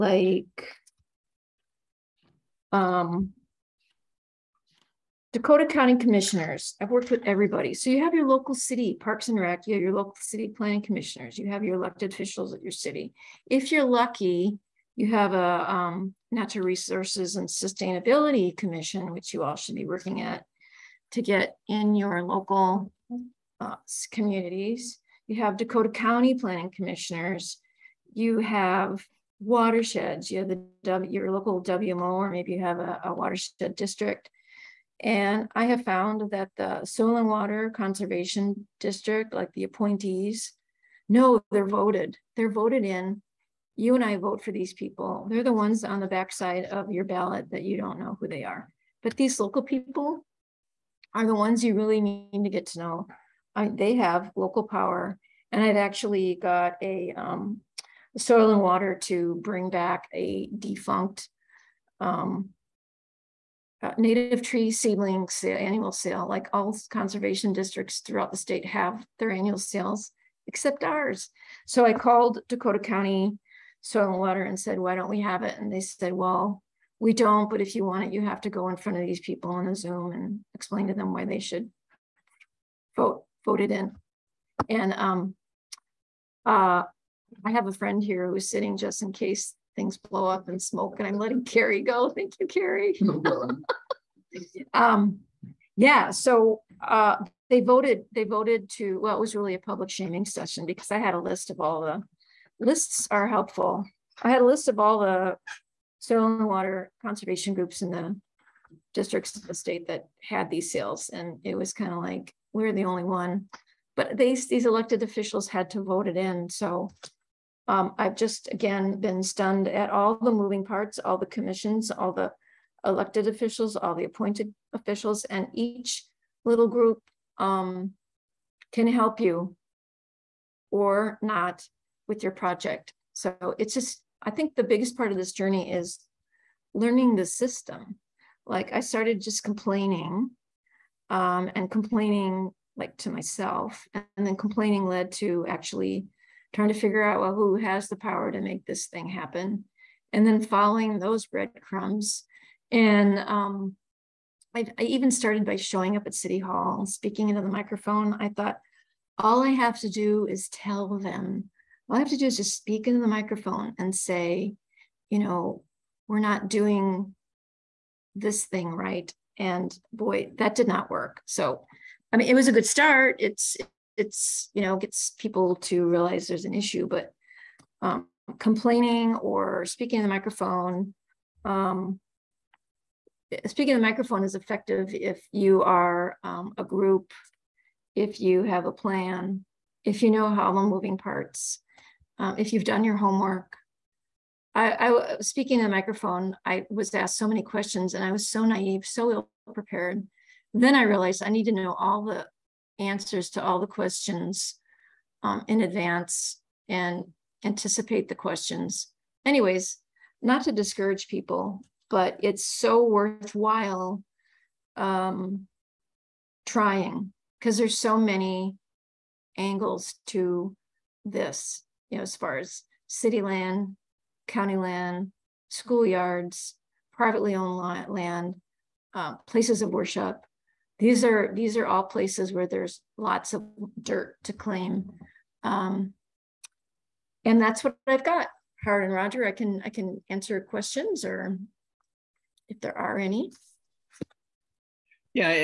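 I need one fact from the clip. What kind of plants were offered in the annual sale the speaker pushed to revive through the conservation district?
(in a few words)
Native tree seedlings.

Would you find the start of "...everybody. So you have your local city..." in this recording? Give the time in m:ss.
0:07.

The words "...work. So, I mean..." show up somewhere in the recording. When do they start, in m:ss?
2:50.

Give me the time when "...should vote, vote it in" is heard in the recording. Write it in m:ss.
1:21.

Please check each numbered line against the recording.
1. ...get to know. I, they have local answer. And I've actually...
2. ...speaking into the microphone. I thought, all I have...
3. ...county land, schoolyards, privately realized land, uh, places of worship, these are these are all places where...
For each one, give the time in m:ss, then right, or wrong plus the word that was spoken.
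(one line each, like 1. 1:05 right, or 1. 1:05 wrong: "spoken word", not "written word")
1. 0:52 wrong: "power", not "answer"
2. 2:36 right
3. 3:44 wrong: "owned", not "realized".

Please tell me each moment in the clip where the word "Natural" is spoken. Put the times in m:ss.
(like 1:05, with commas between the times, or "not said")
0:16.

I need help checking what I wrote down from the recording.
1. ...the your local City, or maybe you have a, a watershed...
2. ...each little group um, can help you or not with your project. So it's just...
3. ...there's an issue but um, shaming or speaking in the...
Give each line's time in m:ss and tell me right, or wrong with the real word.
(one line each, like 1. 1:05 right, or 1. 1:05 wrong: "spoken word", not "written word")
1. 0:30 wrong: "WMO", not "City"
2. 2:05 right
3. 2:56 wrong: "complaining", not "shaming".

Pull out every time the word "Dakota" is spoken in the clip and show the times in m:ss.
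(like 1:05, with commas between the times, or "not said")
0:05, 0:25, 1:12.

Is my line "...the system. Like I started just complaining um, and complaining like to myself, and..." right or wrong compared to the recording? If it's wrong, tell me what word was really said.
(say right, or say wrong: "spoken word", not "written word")
right.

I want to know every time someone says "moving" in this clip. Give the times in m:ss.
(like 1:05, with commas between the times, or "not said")
2:00, 3:10.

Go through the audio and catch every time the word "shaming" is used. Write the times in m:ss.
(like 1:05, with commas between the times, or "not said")
1:39.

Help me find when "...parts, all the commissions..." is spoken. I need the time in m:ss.
2:00.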